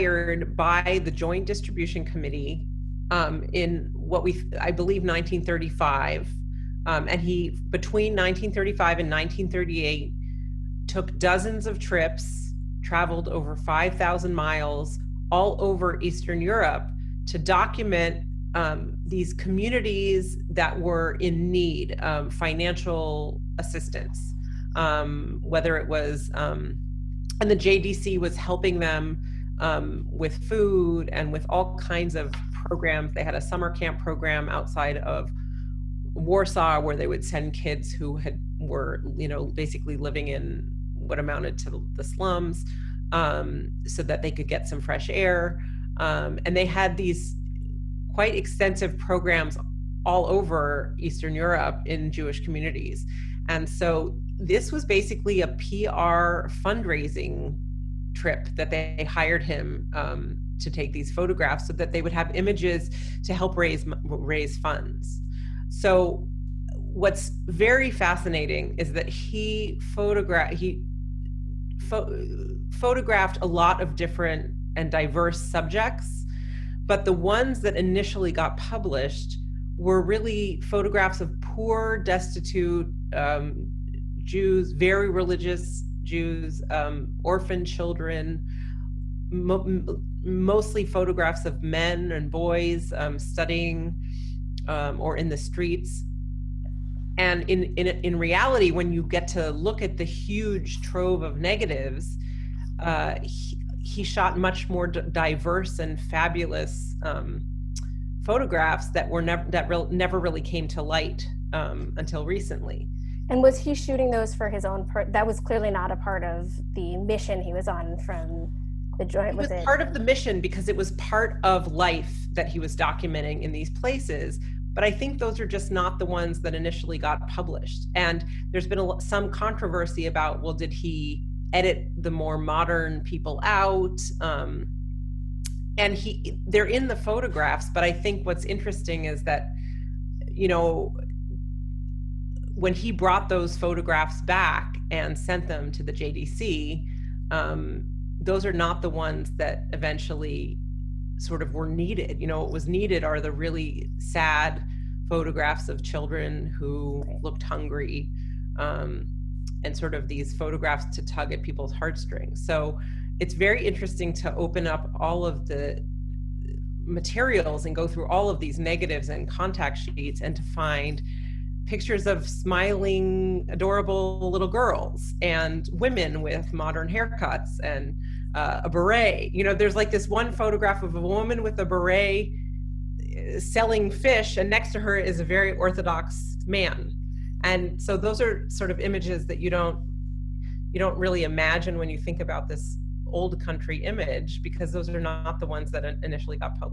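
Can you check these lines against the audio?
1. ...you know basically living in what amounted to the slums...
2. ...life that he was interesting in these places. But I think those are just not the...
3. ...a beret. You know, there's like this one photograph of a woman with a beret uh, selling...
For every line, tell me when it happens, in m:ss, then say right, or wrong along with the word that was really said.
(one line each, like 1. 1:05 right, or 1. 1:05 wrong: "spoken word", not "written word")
1. 0:39 right
2. 2:01 wrong: "documenting", not "interesting"
3. 2:58 right.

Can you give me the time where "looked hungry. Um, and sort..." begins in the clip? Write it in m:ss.
2:37.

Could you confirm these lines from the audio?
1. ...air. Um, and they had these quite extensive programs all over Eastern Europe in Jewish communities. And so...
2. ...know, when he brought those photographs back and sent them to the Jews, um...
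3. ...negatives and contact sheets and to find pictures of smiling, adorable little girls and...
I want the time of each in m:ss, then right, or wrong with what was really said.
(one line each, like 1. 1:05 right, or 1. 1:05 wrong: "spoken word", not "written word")
1. 0:45 right
2. 2:20 wrong: "JDC", not "Jews"
3. 2:48 right.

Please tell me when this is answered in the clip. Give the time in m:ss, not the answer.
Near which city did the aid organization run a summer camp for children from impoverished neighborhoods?
0:36.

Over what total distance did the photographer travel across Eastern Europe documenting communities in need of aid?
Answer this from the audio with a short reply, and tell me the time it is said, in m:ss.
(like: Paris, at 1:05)
over 5,000 miles, at 0:13.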